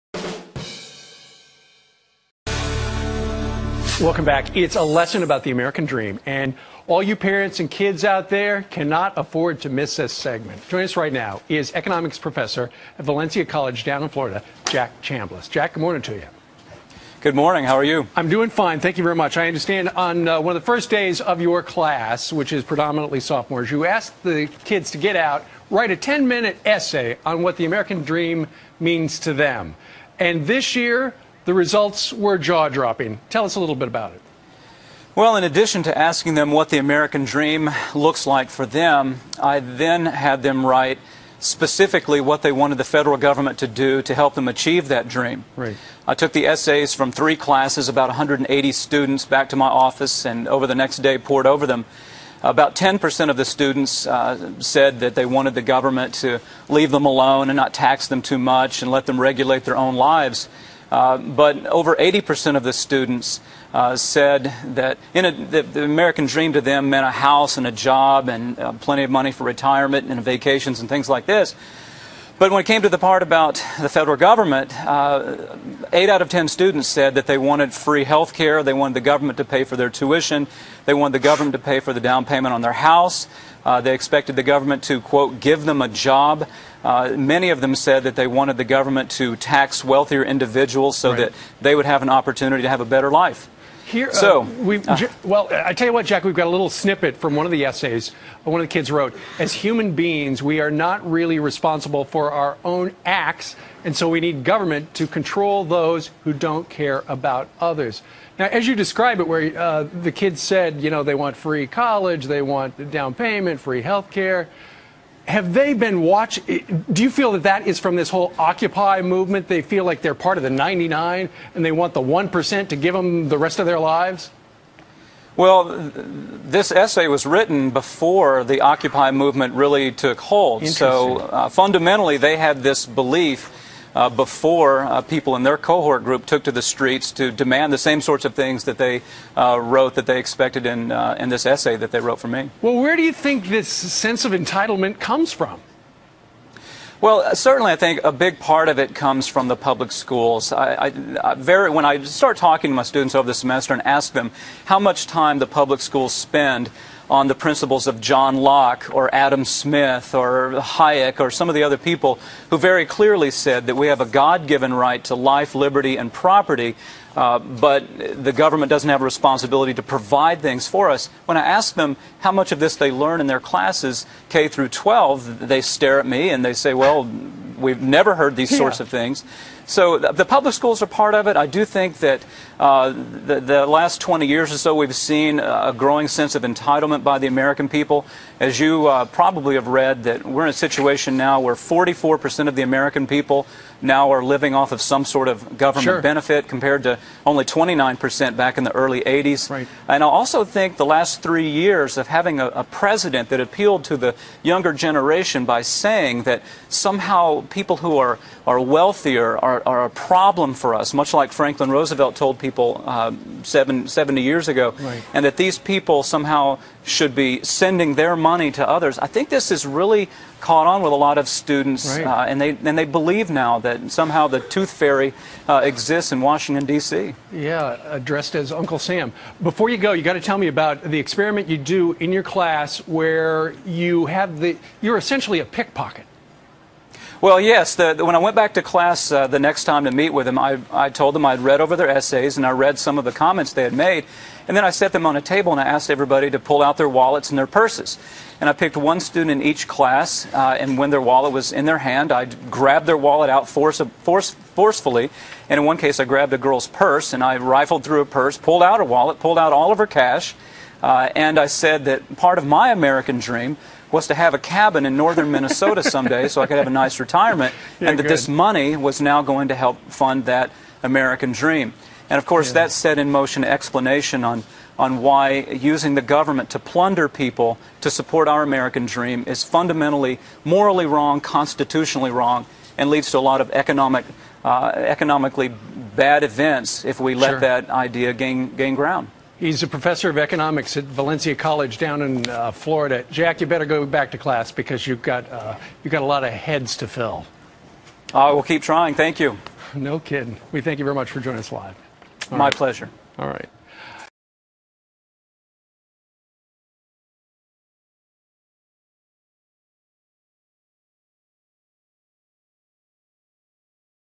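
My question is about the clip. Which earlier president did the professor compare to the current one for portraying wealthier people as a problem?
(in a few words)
Franklin Roosevelt.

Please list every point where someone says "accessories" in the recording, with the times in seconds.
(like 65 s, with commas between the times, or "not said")
not said.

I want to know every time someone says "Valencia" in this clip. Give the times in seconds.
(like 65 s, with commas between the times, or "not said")
13 s, 290 s.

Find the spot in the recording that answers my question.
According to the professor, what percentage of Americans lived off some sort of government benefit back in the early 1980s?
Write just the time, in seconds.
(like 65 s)
197 s.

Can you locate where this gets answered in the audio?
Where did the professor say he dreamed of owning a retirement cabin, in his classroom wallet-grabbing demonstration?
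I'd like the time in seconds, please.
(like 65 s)
264 s.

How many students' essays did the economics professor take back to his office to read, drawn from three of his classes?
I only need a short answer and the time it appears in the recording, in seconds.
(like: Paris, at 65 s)
180, at 48 s.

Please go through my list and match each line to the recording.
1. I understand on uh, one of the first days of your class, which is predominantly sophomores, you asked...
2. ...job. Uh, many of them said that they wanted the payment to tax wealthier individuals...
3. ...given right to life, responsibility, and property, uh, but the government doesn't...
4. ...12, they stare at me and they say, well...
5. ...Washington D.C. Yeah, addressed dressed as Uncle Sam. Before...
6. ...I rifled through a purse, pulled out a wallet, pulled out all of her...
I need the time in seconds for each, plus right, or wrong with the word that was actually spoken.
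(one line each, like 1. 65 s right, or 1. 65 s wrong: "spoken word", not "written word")
1. 19 s right
2. 85 s wrong: "government", not "payment"
3. 164 s wrong: "liberty", not "responsibility"
4. 174 s right
5. 226 s right
6. 257 s right.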